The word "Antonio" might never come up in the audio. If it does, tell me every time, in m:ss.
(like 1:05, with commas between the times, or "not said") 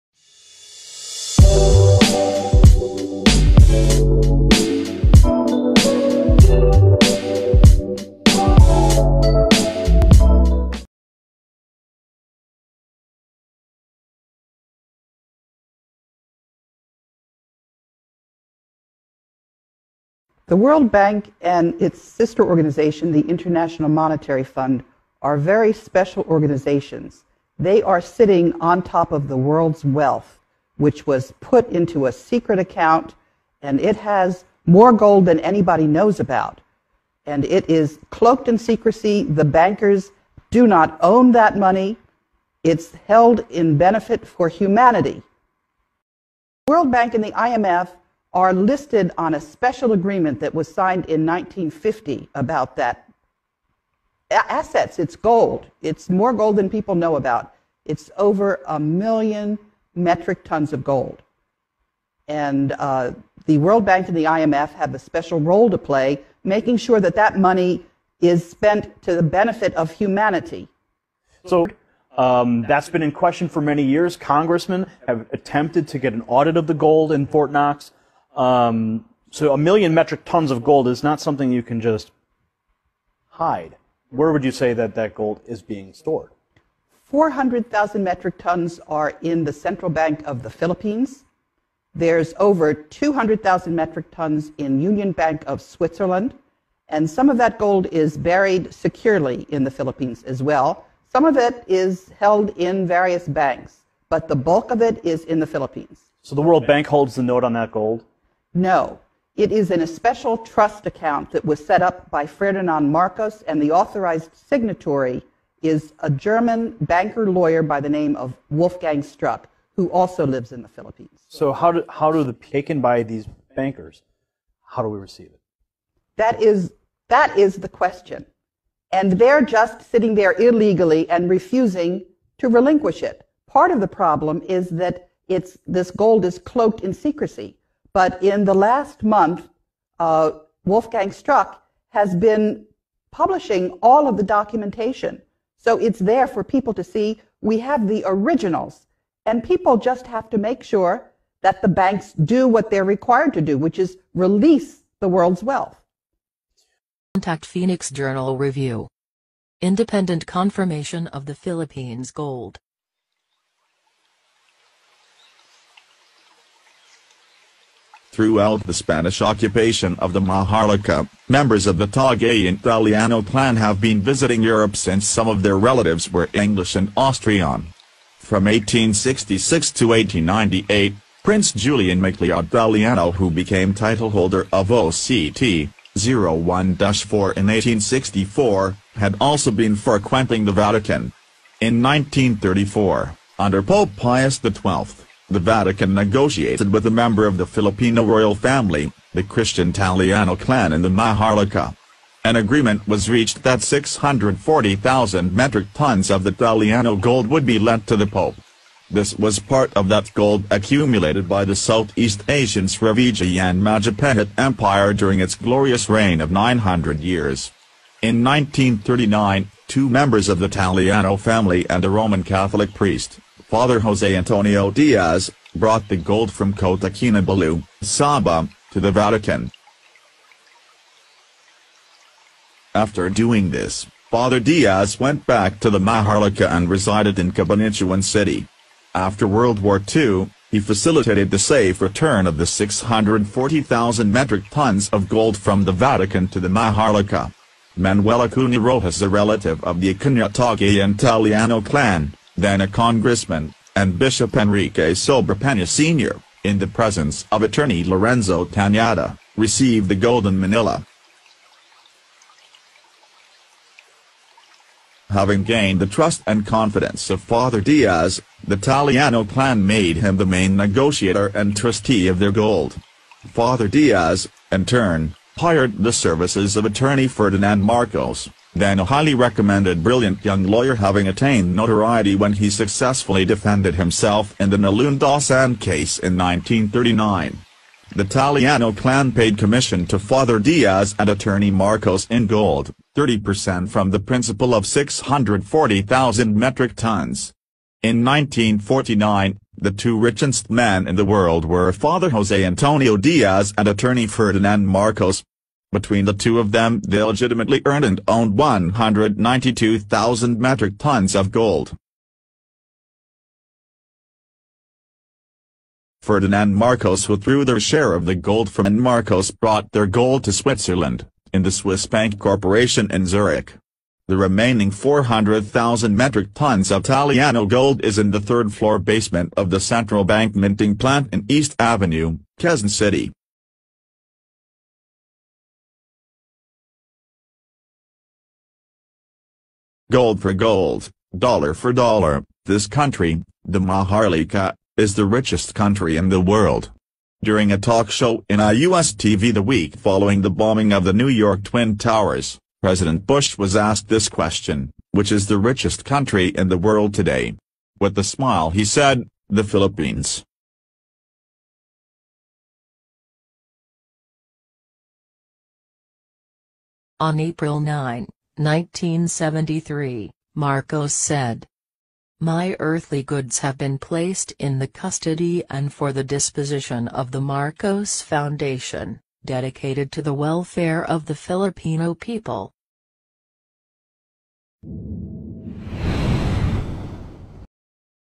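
3:44, 5:02.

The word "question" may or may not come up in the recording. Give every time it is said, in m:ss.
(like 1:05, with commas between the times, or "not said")
1:13, 2:07, 5:54.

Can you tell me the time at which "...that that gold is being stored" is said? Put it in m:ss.
1:24.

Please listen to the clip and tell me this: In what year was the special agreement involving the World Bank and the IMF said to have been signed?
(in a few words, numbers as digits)
1950.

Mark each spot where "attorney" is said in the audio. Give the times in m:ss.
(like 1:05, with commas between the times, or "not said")
4:17, 4:36, 4:51, 5:03.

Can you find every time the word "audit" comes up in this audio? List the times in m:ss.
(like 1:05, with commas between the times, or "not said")
1:16.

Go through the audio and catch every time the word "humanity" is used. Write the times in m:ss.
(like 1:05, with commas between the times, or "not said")
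0:44, 1:09.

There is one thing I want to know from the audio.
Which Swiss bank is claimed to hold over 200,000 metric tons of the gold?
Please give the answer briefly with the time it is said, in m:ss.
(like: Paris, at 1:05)
Union Bank of Switzerland, at 1:34.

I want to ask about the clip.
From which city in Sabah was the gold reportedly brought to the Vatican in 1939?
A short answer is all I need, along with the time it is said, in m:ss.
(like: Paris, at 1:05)
Kota Kinabalu, at 3:46.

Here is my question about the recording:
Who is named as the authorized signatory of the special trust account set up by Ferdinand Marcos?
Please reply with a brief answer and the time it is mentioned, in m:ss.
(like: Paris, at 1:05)
Wolfgang Strupp, at 1:58.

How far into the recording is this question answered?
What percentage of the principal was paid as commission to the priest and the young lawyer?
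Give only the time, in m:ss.
4:52.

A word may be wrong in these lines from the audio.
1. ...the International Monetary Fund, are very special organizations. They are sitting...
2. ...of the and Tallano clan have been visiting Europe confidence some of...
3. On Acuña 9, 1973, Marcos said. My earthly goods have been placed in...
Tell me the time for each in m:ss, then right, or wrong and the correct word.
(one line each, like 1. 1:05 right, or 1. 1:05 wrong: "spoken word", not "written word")
1. 0:23 right
2. 2:51 wrong: "since", not "confidence"
3. 6:07 wrong: "April", not "Acuña".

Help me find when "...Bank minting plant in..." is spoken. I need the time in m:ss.
5:30.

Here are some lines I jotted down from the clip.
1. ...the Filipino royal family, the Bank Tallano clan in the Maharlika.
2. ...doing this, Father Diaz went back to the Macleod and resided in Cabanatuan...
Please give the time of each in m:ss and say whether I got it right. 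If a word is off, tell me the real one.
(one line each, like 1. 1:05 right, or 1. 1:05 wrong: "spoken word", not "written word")
1. 3:17 wrong: "Christian", not "Bank"
2. 3:53 wrong: "Maharlika", not "Macleod".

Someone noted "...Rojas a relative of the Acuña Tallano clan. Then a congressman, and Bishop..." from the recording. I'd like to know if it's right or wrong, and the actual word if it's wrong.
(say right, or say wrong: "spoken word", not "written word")
right.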